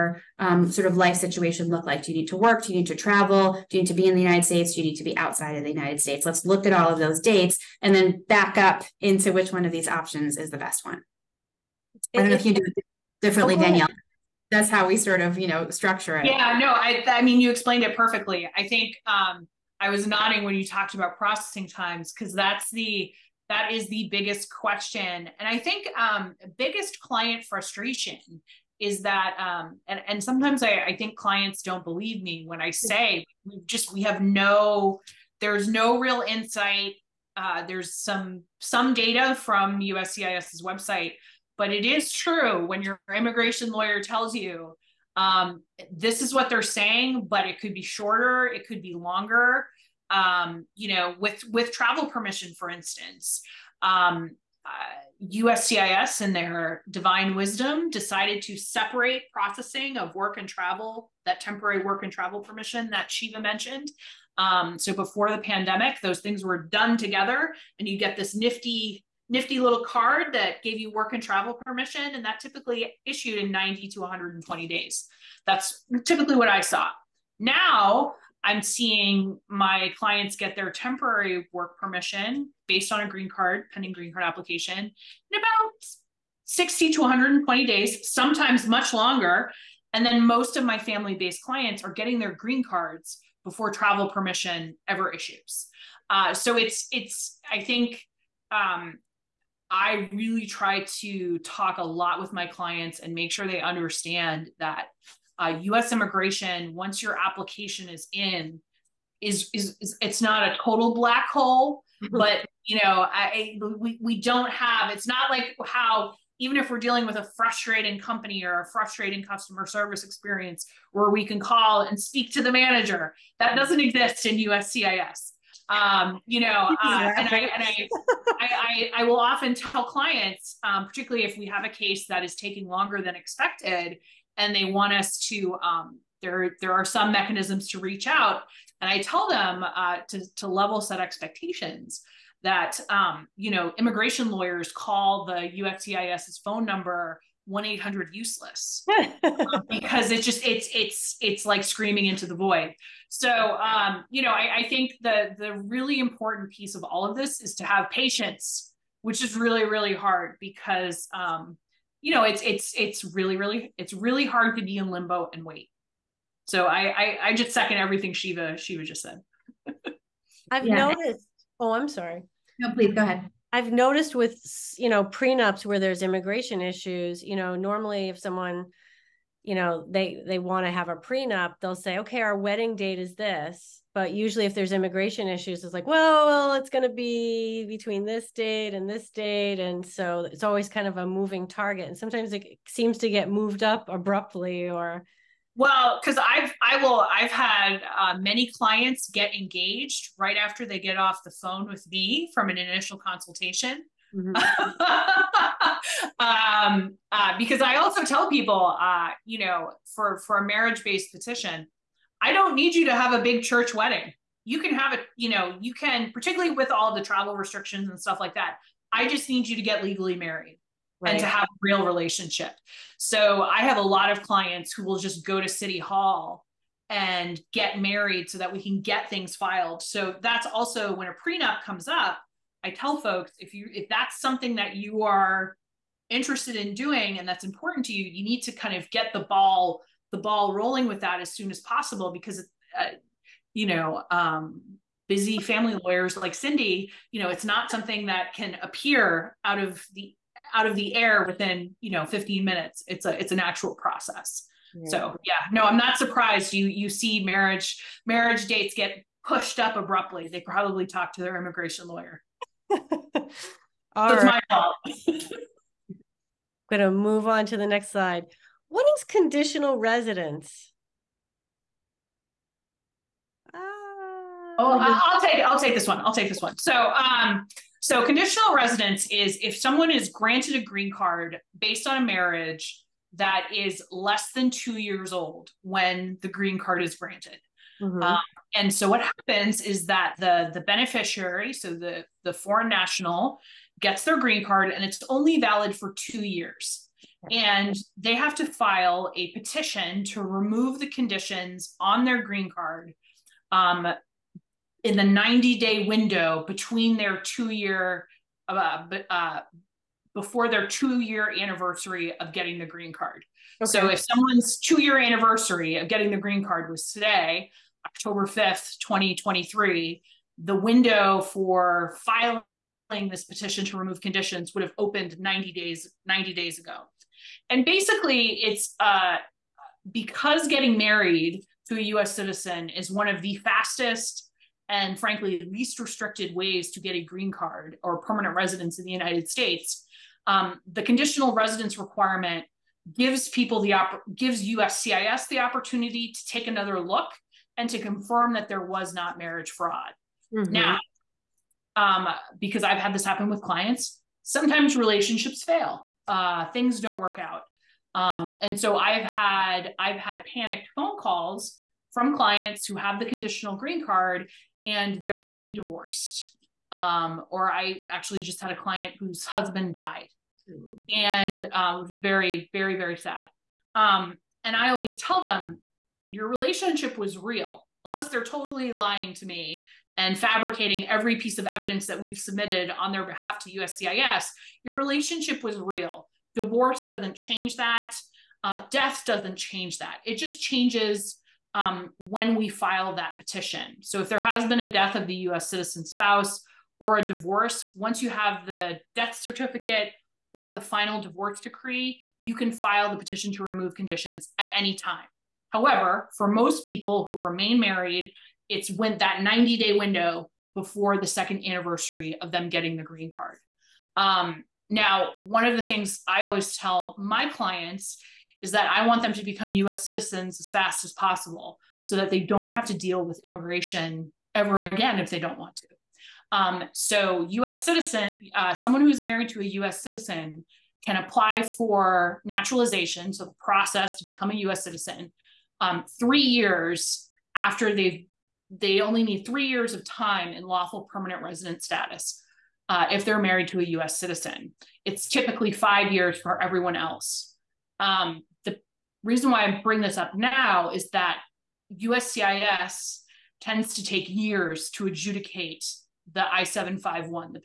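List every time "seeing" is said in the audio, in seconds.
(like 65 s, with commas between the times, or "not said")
78 s.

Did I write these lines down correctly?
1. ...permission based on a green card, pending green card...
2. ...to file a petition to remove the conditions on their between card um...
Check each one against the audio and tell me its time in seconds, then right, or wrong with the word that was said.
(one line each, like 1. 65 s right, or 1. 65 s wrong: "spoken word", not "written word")
1. 81 s right
2. 298 s wrong: "green", not "between".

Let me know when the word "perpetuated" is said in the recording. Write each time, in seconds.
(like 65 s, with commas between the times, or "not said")
not said.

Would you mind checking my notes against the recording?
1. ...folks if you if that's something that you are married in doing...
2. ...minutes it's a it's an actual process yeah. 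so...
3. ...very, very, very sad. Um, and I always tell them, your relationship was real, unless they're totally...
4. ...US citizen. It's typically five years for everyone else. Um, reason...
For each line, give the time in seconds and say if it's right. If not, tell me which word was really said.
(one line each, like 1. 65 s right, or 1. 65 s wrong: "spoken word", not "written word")
1. 232 s wrong: "interested", not "married"
2. 252 s right
3. 371 s right
4. 443 s right.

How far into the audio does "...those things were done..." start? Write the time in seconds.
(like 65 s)
65 s.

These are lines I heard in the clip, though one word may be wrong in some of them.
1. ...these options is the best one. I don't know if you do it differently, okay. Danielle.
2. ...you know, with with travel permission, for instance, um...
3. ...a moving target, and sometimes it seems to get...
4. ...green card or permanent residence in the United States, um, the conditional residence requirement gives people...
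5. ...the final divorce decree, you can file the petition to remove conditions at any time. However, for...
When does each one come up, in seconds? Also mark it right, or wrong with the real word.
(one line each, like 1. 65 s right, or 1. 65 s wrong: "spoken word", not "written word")
1. 9 s right
2. 50 s right
3. 190 s right
4. 337 s right
5. 400 s right.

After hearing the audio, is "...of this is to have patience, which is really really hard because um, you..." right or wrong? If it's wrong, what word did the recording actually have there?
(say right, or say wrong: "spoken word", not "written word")
right.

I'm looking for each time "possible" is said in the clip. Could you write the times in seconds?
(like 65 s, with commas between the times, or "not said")
241 s, 420 s.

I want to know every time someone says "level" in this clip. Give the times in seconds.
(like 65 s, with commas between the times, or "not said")
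140 s.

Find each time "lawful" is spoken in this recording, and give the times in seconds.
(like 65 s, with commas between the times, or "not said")
440 s.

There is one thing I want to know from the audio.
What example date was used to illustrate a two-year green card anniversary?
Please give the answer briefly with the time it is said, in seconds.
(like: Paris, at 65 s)
October 5th, 2023, at 317 s.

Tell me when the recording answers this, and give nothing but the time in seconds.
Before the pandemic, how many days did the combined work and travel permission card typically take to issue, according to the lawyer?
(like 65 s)
73 s.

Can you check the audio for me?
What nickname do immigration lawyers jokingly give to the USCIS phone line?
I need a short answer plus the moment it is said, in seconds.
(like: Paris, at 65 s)
1-800-useless, at 147 s.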